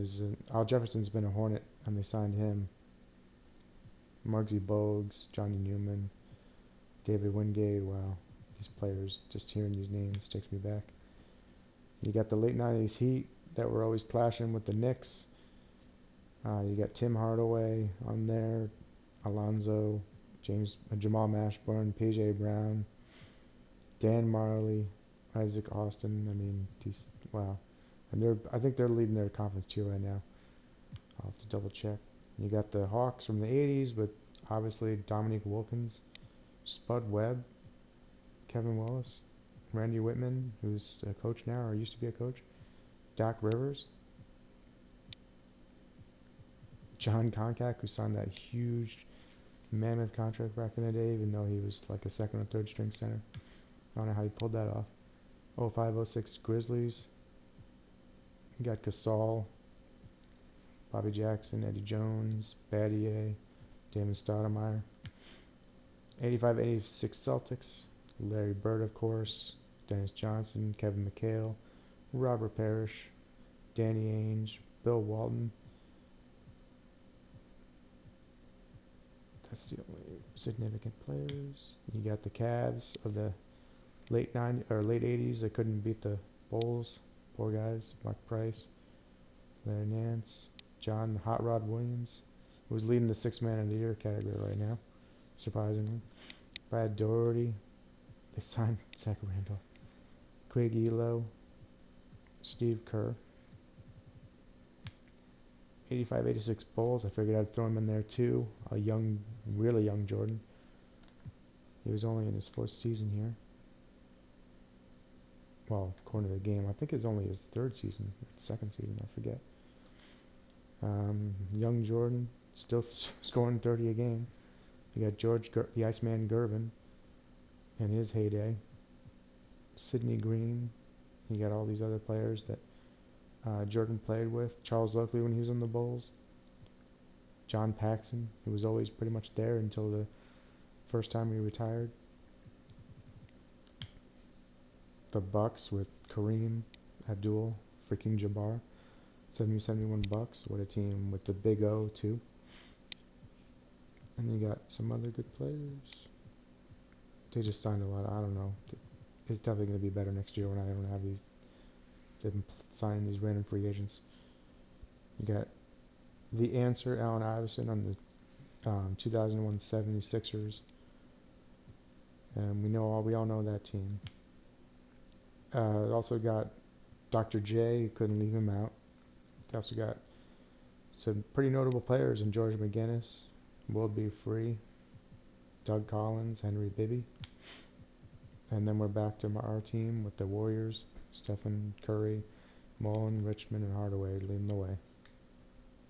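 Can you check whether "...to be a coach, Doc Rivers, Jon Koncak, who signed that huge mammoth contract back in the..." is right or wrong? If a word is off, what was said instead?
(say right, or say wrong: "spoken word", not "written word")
right.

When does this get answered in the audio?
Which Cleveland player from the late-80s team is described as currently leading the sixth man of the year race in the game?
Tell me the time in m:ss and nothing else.
1:30.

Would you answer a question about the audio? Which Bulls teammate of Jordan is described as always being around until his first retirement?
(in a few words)
John Paxson.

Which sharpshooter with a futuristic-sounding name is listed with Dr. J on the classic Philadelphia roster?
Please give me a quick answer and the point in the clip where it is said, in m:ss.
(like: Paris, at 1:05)
World B. Free, at 3:03.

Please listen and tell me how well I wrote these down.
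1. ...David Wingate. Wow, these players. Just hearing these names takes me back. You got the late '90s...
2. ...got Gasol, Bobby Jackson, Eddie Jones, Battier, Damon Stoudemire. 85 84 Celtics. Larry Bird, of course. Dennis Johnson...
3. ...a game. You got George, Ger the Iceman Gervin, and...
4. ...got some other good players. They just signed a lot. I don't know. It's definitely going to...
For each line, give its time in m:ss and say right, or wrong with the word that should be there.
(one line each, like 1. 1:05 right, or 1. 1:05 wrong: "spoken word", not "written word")
1. 0:07 right
2. 0:58 wrong: "86", not "84"
3. 2:03 right
4. 2:34 right.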